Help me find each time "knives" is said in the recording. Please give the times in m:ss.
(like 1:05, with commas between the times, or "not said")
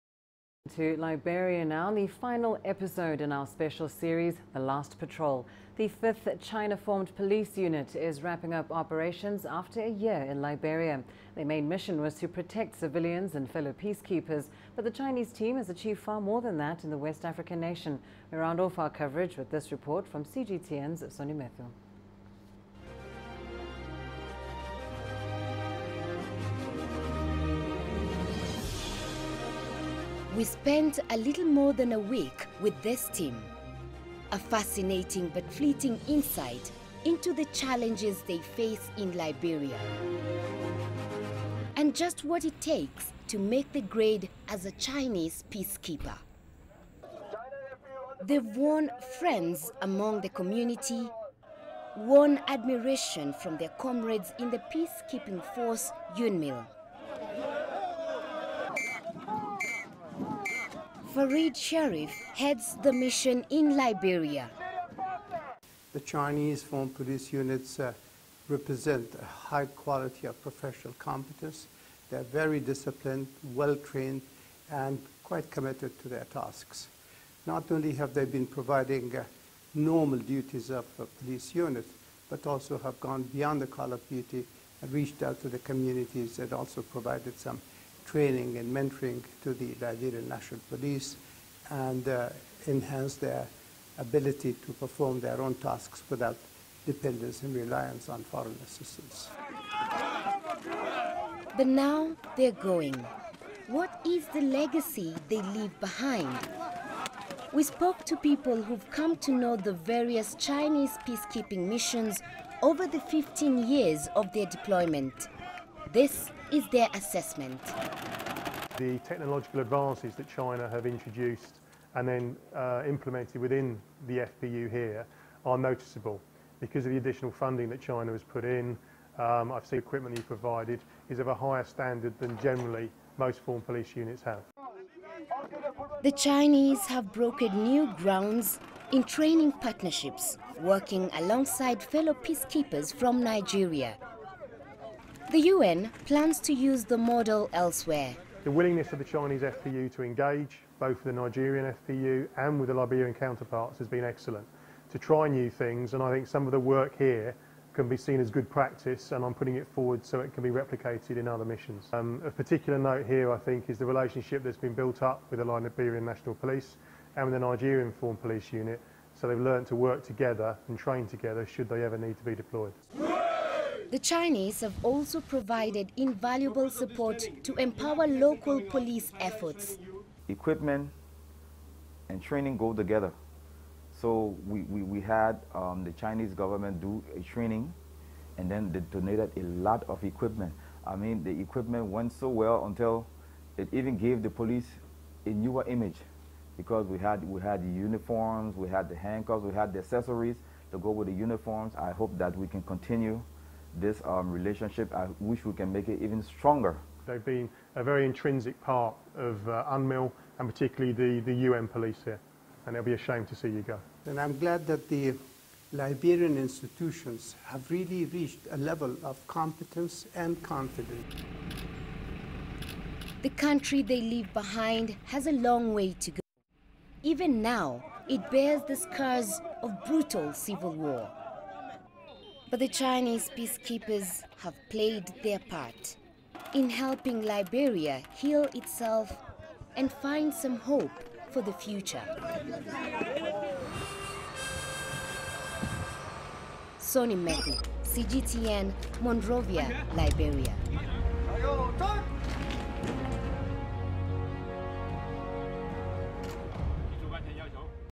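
not said.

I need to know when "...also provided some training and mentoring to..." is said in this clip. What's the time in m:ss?
1:26.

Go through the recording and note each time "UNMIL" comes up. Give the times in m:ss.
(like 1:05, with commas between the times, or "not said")
0:56, 3:29.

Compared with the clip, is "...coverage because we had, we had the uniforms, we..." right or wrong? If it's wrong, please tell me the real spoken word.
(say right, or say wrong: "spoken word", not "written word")
wrong: "image", not "coverage".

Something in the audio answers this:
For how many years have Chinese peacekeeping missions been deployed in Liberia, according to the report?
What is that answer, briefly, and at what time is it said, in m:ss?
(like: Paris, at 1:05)
15, at 1:52.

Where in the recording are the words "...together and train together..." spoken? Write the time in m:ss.
2:50.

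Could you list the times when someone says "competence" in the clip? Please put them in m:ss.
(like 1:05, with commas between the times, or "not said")
1:10, 3:39.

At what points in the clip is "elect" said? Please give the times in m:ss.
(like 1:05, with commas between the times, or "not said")
not said.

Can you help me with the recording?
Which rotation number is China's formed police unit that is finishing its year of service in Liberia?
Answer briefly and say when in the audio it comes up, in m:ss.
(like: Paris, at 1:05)
5th, at 0:06.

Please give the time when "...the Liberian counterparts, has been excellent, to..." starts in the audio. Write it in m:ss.
2:32.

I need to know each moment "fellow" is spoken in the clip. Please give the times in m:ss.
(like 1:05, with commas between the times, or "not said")
0:13, 2:21.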